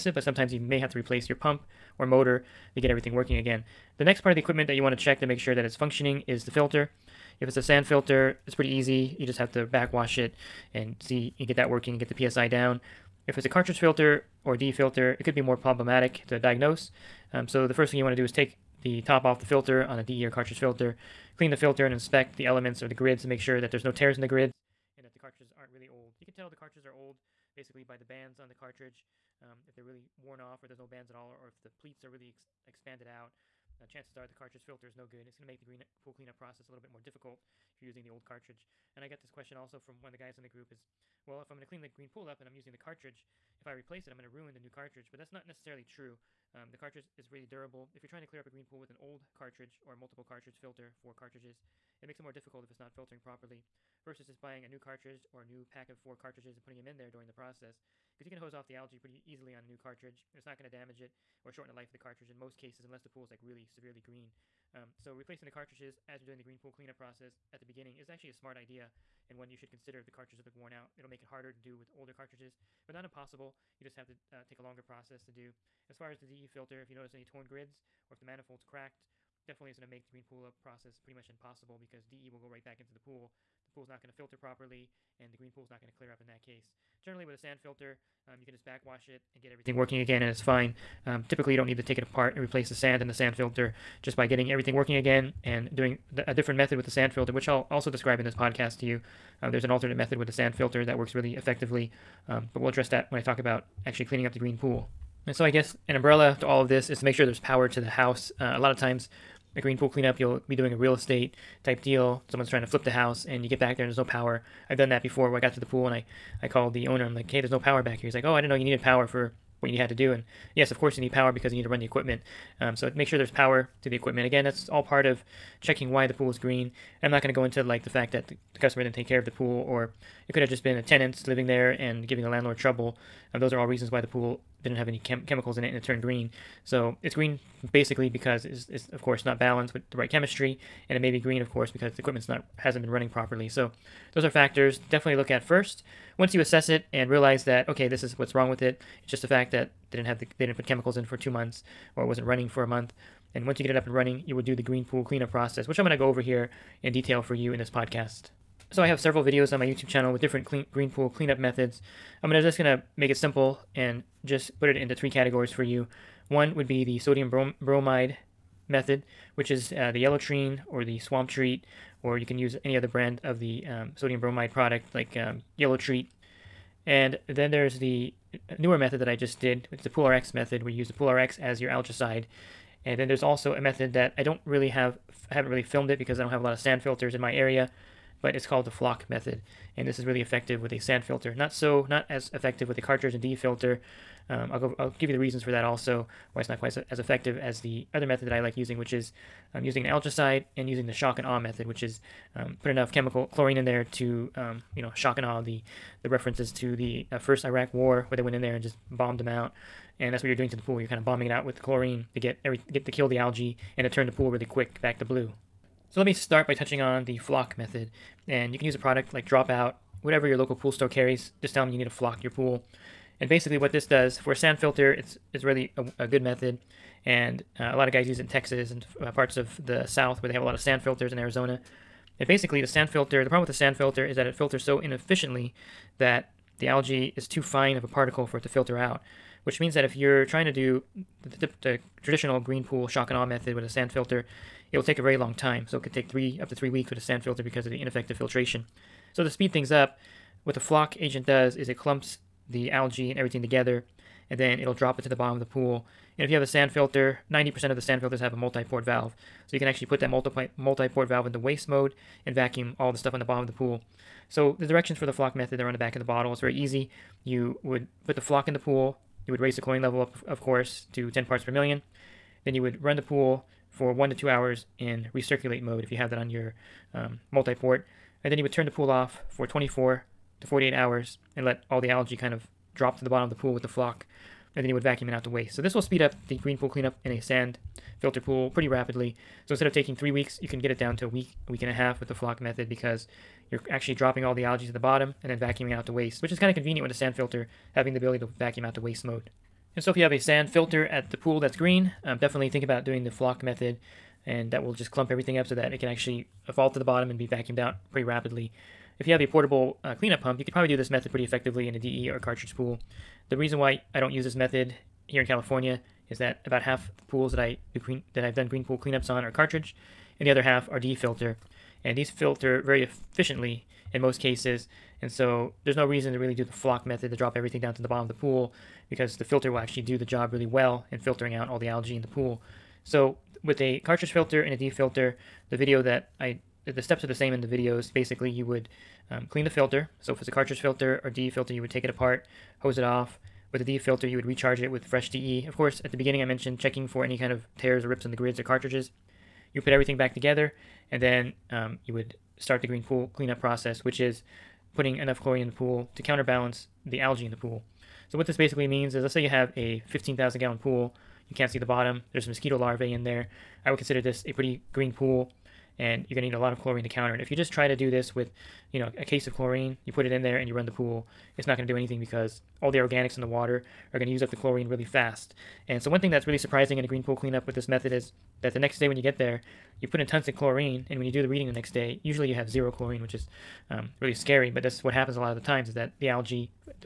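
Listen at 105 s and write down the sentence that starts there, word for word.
And so I guess an umbrella to all of this is to make sure there's power to the house.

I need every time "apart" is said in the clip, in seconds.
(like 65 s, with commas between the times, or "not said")
92 s, 341 s.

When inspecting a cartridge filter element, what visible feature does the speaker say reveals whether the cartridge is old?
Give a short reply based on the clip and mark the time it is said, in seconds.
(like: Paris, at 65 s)
The bands, at 27 s.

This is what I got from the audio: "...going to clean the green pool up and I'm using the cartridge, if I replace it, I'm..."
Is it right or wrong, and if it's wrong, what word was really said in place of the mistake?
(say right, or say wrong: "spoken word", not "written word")
right.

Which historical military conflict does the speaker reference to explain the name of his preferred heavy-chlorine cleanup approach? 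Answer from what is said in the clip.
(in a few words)
First Iraq War.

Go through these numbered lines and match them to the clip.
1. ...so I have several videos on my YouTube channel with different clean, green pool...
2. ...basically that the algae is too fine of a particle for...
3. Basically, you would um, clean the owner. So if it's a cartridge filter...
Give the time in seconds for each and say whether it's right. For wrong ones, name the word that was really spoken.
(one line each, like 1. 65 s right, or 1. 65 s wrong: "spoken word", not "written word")
1. 158 s right
2. 234 s wrong: "inefficiently", not "basically"
3. 337 s wrong: "filter", not "owner".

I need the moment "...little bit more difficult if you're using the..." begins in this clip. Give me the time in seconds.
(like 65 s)
36 s.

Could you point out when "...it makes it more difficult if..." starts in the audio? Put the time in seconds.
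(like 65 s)
52 s.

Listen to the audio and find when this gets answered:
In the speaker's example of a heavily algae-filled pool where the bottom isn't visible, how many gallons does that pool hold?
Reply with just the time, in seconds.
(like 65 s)
359 s.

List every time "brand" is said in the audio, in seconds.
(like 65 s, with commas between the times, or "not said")
172 s.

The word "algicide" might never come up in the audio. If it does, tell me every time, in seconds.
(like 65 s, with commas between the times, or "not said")
181 s, 199 s.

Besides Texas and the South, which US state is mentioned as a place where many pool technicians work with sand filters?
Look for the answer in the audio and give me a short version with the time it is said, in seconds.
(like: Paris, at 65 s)
Arizona, at 231 s.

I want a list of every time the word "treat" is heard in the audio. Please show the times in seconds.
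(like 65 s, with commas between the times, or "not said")
171 s, 175 s.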